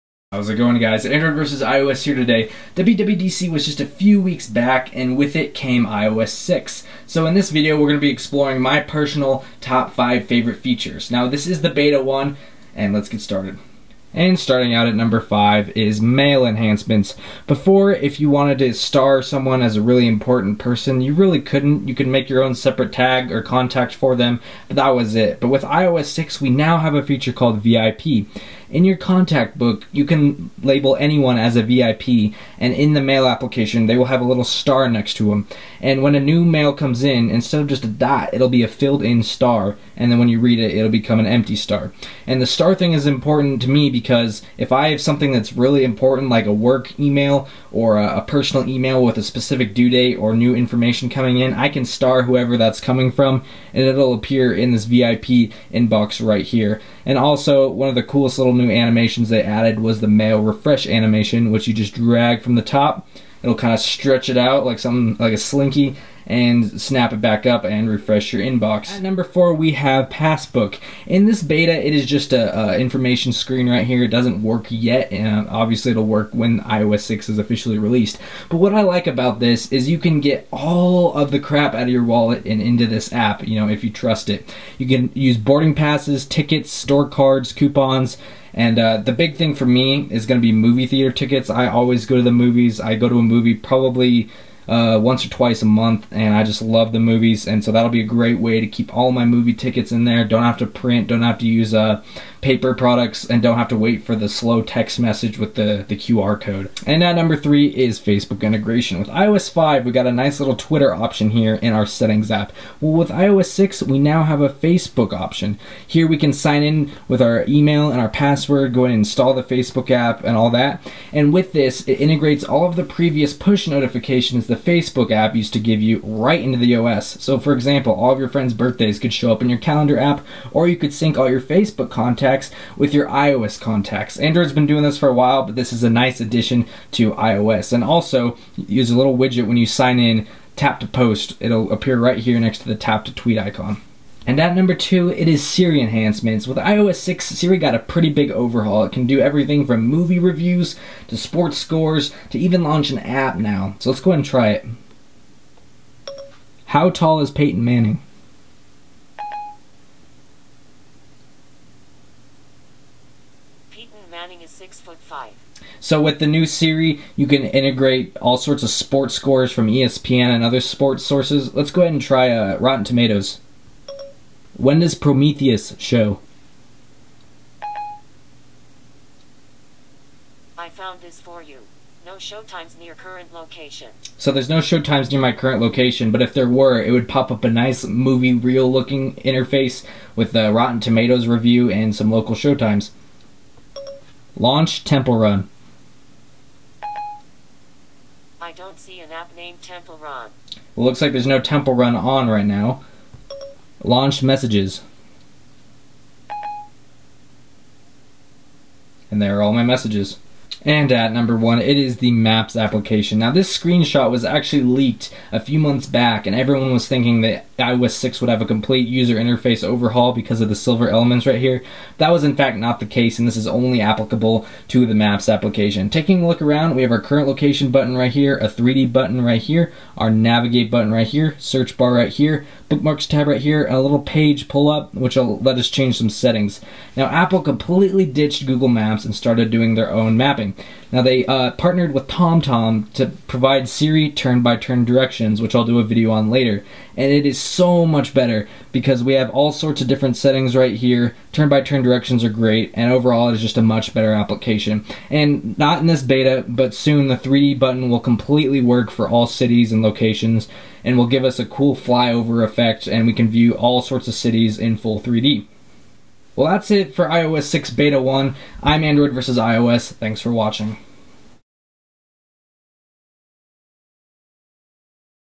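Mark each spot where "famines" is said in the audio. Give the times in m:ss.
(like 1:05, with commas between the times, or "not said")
not said.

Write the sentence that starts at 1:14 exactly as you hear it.
It doesn't work yet, and obviously it'll work when iOS 6 is officially released.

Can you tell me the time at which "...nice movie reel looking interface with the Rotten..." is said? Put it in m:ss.
3:07.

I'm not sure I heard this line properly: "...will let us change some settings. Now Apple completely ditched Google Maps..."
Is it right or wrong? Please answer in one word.
right.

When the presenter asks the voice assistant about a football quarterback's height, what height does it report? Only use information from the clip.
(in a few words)
six foot five.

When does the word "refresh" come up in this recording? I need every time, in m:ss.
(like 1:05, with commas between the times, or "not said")
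1:00, 1:07.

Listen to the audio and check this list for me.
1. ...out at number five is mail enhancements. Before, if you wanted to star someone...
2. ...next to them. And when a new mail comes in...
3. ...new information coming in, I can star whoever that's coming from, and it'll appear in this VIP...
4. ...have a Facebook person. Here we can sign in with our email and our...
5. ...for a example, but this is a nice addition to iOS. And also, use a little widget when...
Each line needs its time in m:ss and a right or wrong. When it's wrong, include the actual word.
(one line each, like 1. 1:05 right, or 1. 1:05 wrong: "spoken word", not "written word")
1. 0:14 right
2. 0:34 right
3. 0:50 right
4. 1:54 wrong: "option", not "person"
5. 2:14 wrong: "while", not "example".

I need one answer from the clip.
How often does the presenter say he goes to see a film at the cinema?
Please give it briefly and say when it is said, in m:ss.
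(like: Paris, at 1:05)
once or twice a month, at 1:34.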